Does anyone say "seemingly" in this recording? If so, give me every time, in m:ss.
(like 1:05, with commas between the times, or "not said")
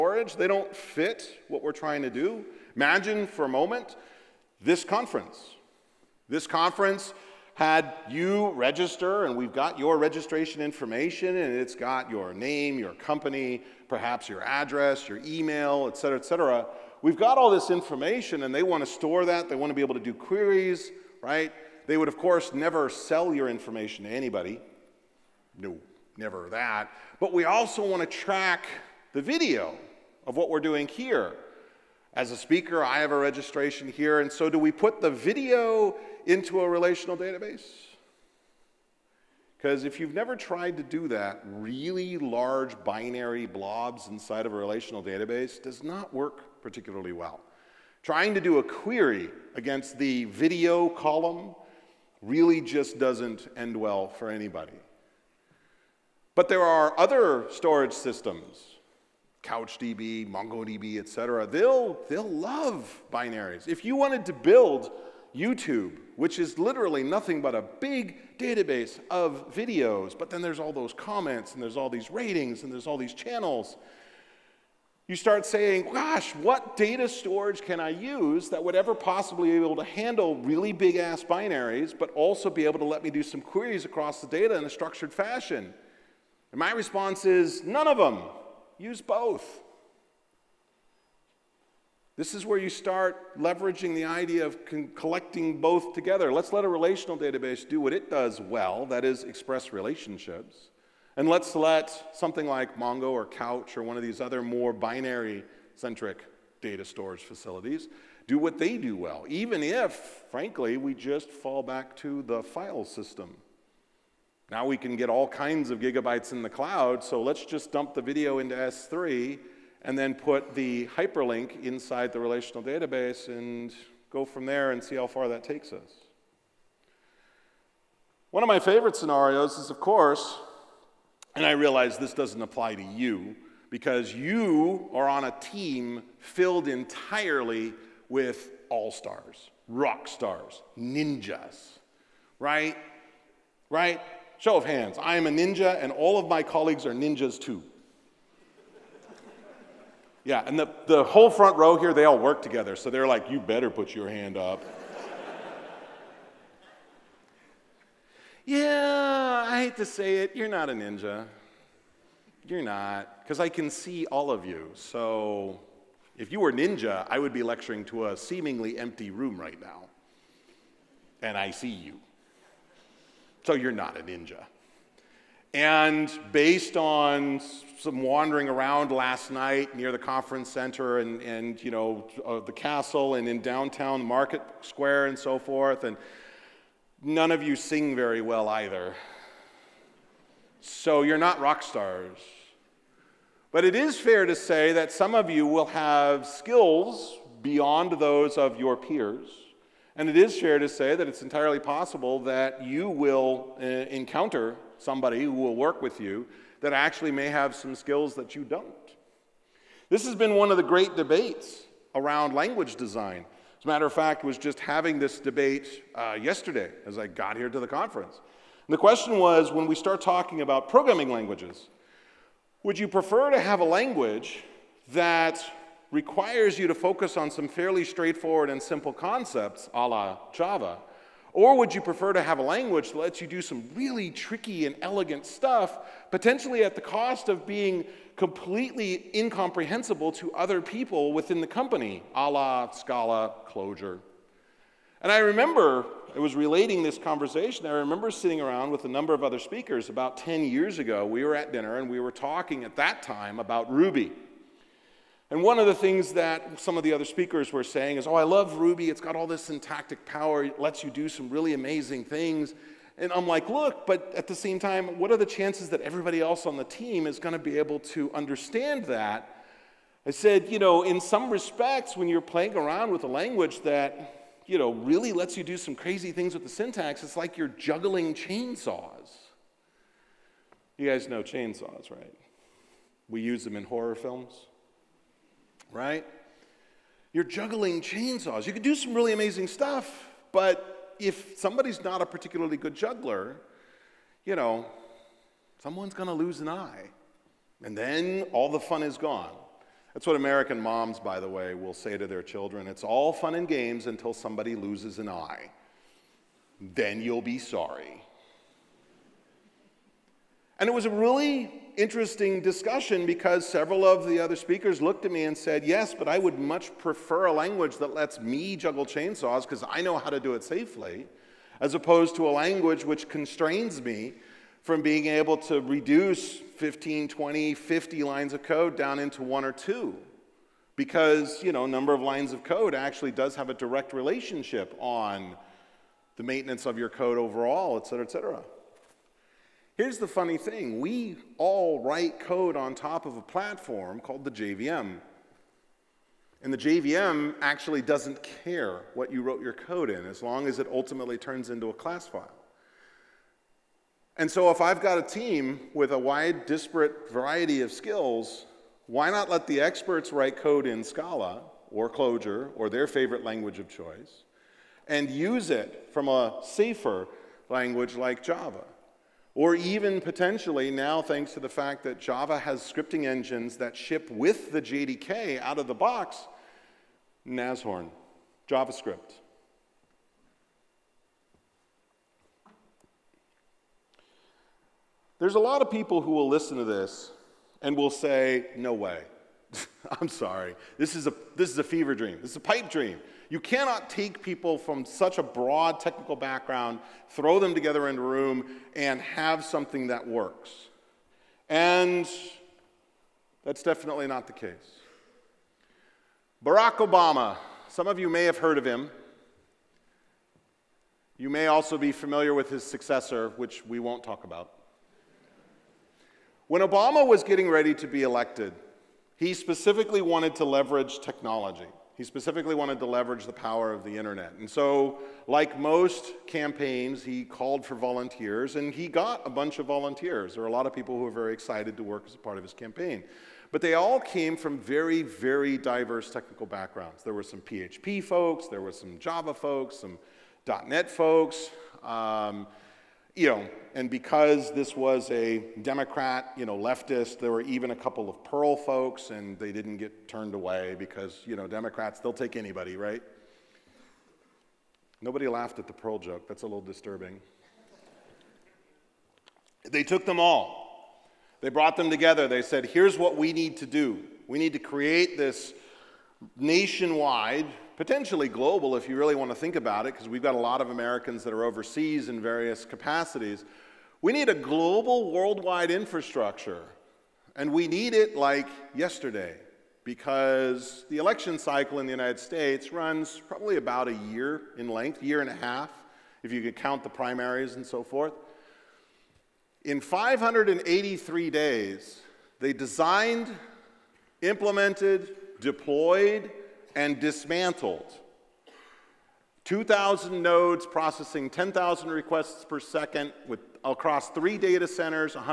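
2:48.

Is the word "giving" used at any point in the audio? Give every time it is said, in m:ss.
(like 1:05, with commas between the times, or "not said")
not said.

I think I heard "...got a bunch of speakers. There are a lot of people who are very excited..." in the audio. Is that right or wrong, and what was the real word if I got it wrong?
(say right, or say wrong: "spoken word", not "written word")
wrong: "volunteers", not "speakers".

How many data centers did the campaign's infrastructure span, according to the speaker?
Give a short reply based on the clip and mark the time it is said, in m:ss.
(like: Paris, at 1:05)
3, at 8:24.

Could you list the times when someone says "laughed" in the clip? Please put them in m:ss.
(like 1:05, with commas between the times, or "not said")
7:35.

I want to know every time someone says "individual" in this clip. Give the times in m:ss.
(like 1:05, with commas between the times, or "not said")
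not said.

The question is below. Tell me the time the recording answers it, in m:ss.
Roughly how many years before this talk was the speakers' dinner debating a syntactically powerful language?
4:10.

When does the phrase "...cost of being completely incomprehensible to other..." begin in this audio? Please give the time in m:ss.
3:56.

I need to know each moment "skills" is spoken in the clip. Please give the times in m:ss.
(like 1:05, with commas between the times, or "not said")
3:16, 3:27, 5:57.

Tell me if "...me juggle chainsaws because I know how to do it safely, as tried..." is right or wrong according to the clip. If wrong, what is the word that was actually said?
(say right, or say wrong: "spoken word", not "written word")
wrong: "opposed", not "tried".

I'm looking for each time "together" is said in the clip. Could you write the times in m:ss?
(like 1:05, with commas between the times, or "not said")
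1:35, 2:32, 6:37, 7:41.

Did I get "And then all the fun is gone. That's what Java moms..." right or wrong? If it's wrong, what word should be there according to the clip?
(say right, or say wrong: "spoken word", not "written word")
wrong: "American", not "Java".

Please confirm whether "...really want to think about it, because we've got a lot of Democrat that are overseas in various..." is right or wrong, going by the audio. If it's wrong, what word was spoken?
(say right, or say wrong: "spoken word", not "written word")
wrong: "Americans", not "Democrat".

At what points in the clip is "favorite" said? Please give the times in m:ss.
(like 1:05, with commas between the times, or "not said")
2:08, 6:02.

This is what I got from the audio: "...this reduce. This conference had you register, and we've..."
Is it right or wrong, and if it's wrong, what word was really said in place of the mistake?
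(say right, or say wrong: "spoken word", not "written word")
wrong: "conference", not "reduce".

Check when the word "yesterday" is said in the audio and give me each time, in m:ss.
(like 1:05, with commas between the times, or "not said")
3:36, 7:58.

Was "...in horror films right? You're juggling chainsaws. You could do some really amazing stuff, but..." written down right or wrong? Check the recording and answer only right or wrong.
right.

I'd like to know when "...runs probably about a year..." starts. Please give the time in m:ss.
8:02.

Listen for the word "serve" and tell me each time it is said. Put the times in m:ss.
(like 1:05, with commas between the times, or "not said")
not said.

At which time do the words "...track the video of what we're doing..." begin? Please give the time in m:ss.
0:28.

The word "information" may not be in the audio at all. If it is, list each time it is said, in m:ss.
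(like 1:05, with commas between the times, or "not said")
0:10, 0:17, 0:23.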